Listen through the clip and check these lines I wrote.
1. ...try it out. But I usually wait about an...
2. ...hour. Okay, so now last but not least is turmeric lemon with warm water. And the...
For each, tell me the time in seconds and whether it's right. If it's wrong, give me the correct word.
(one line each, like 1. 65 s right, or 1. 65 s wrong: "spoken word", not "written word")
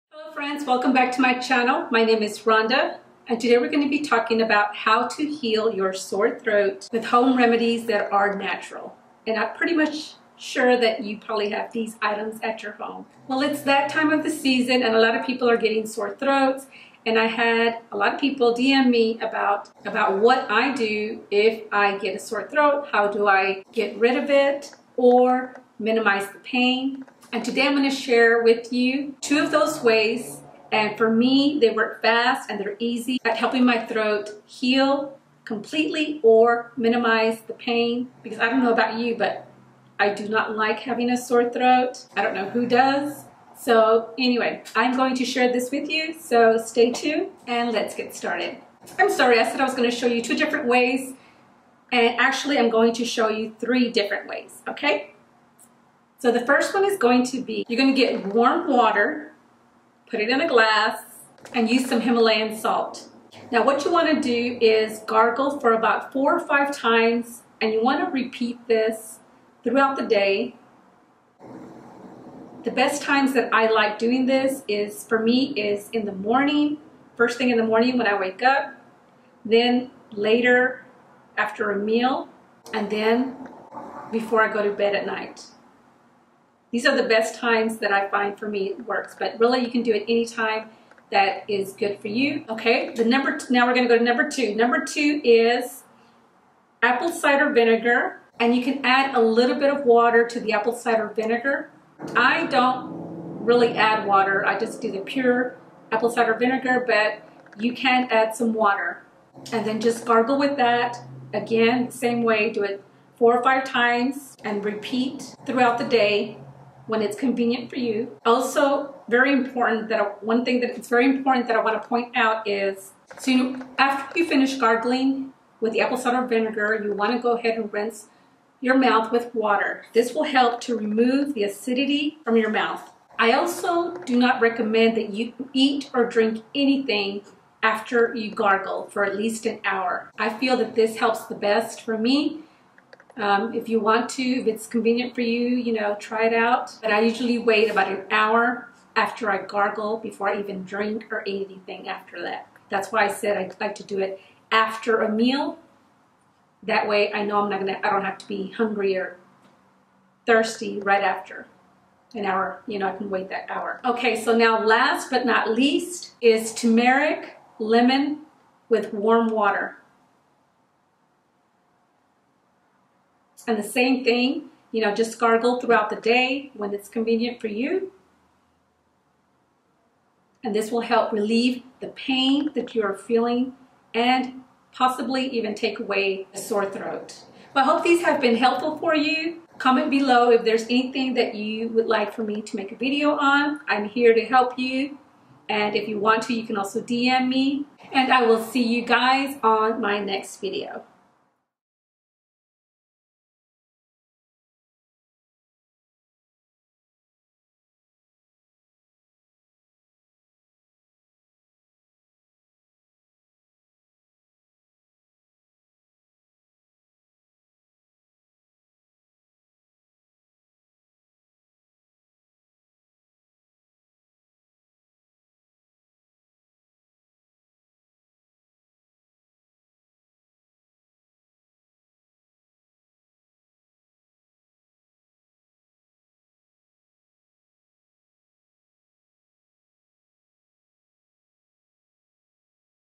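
1. 145 s right
2. 163 s right.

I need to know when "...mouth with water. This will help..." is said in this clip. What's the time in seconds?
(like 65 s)
128 s.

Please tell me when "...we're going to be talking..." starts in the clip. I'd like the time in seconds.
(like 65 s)
3 s.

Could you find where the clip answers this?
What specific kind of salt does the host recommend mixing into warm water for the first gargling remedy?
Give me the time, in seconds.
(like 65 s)
62 s.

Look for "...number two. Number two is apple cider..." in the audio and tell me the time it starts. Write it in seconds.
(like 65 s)
94 s.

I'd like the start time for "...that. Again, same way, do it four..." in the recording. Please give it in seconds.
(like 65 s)
110 s.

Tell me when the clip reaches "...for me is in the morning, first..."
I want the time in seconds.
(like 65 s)
75 s.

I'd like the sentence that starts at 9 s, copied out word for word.
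And I'm pretty much sure that you probably have these items at your home.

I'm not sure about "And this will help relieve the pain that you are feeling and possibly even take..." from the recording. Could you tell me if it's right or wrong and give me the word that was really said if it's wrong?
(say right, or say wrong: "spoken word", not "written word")
right.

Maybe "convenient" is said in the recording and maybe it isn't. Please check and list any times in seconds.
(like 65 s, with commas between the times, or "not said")
117 s, 144 s, 176 s.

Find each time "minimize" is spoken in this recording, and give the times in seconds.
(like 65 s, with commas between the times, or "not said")
25 s, 36 s.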